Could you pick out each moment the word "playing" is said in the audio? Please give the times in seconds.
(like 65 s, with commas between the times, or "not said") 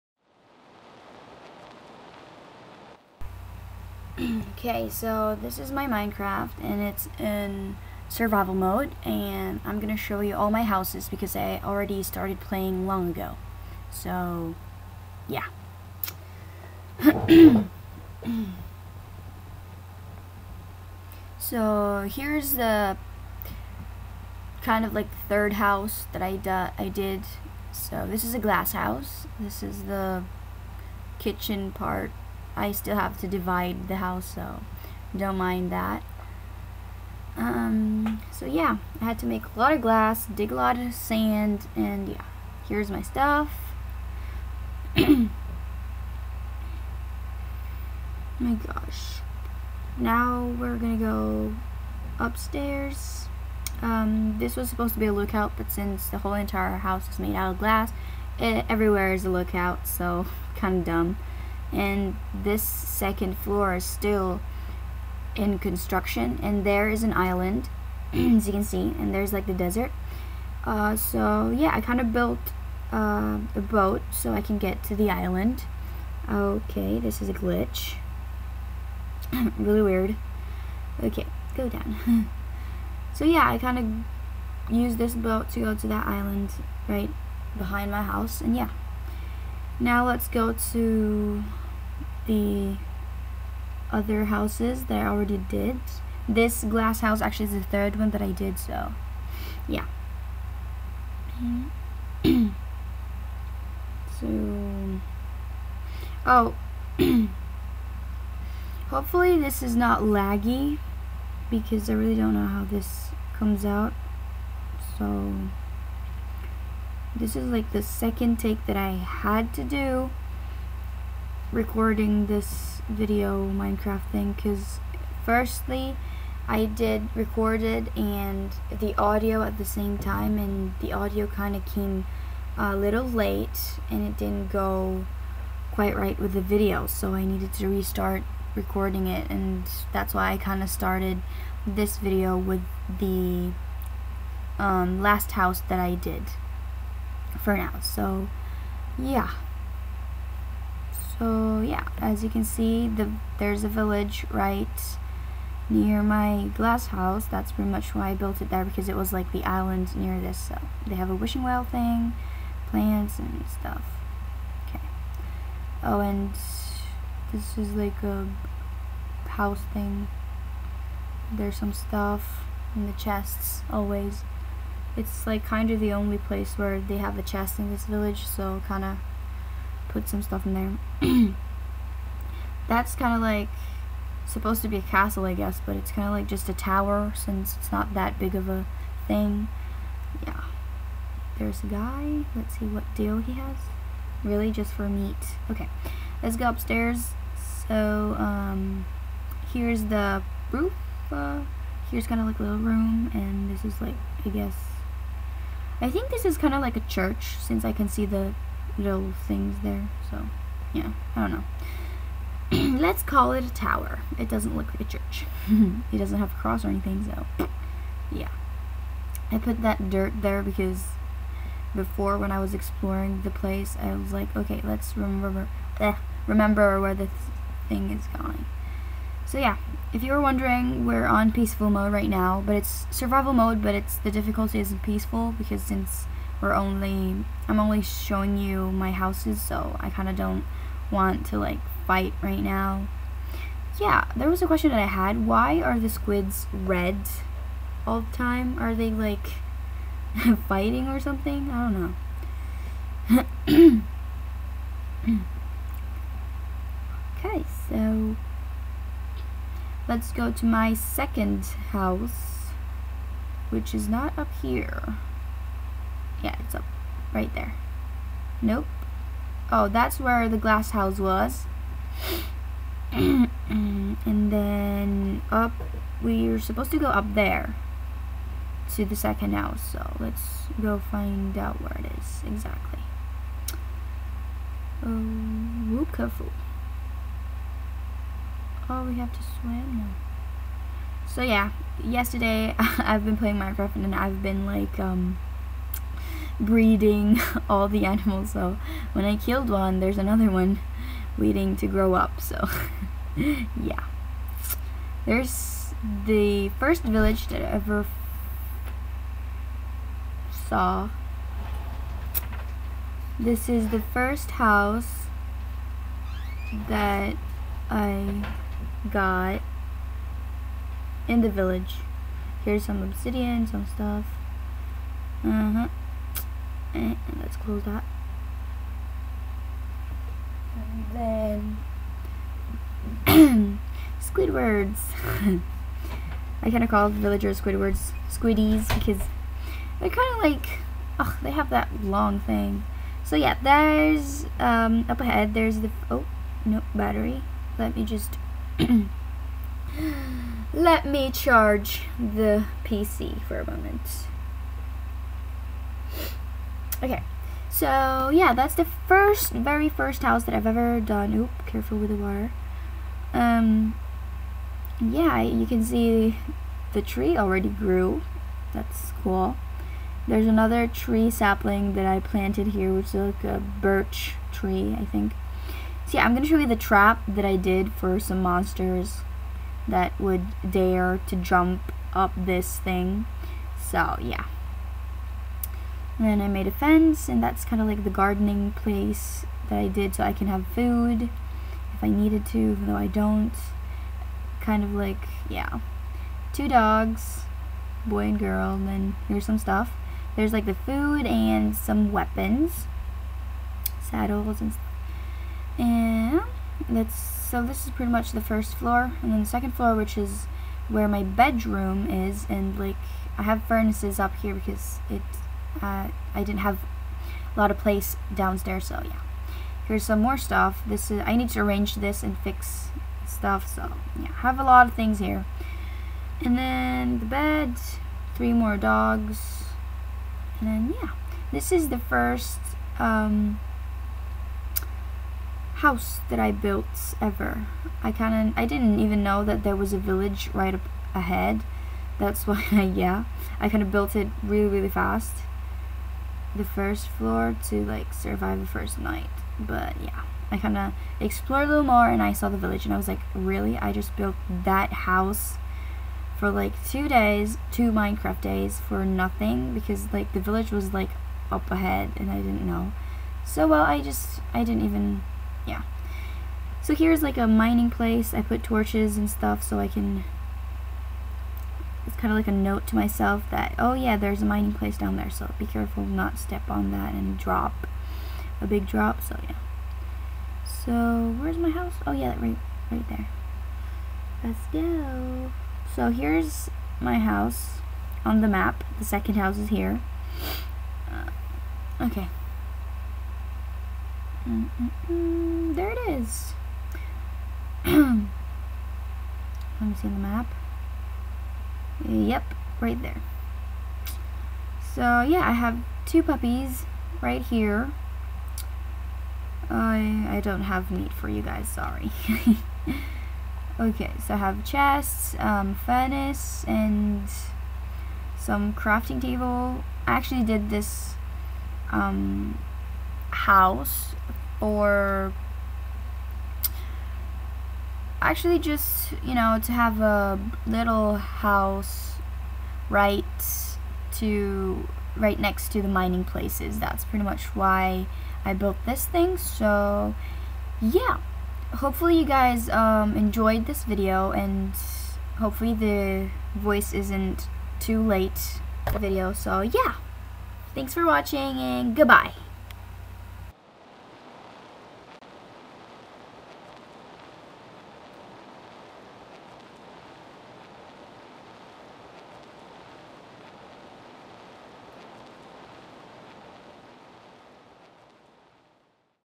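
12 s, 293 s.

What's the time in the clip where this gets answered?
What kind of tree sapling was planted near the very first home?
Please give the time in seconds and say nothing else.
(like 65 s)
373 s.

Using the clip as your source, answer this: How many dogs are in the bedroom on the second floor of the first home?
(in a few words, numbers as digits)
3.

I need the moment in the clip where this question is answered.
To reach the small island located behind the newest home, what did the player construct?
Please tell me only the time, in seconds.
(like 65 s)
73 s.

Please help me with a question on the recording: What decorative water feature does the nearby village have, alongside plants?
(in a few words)
A wishing well.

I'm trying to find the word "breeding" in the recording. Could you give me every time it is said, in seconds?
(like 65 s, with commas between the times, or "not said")
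296 s.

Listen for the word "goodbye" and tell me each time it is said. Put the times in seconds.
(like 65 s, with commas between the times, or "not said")
551 s.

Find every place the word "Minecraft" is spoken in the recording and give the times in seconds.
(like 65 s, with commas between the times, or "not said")
5 s, 123 s, 293 s, 457 s.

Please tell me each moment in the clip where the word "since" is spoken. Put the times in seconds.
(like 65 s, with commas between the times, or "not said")
55 s, 187 s, 207 s, 235 s.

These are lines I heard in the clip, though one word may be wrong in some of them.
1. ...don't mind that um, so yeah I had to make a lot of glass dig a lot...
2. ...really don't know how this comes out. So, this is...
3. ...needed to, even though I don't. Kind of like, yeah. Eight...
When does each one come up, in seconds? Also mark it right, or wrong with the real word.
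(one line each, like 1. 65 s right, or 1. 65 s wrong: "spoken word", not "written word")
1. 35 s right
2. 111 s right
3. 391 s wrong: "Two", not "Eight".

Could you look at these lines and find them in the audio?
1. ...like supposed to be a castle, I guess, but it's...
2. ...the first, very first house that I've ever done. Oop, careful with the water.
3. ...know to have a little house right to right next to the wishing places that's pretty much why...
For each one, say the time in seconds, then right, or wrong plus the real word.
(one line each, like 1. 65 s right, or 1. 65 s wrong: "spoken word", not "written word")
1. 183 s right
2. 358 s right
3. 529 s wrong: "mining", not "wishing".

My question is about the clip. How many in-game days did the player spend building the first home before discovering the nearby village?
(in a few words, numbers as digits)
2.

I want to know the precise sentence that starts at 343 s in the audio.
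So yeah, there's um, up ahead.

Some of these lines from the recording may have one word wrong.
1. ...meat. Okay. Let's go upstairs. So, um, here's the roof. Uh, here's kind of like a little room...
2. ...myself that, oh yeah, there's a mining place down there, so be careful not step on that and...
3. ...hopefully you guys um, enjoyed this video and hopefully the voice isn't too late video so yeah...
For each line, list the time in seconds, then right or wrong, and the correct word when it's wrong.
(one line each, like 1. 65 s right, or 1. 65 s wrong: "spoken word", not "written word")
1. 194 s right
2. 472 s right
3. 541 s right.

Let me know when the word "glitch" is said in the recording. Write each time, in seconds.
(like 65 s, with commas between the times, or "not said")
77 s.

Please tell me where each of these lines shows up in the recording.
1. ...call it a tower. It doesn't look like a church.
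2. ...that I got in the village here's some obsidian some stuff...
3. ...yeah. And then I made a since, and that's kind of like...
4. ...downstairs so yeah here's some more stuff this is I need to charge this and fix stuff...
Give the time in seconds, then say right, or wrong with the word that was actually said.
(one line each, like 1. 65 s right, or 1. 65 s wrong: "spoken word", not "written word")
1. 213 s right
2. 316 s right
3. 384 s wrong: "fence", not "since"
4. 418 s wrong: "arrange", not "charge".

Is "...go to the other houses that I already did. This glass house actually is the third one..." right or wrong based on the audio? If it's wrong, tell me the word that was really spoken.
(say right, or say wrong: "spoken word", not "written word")
right.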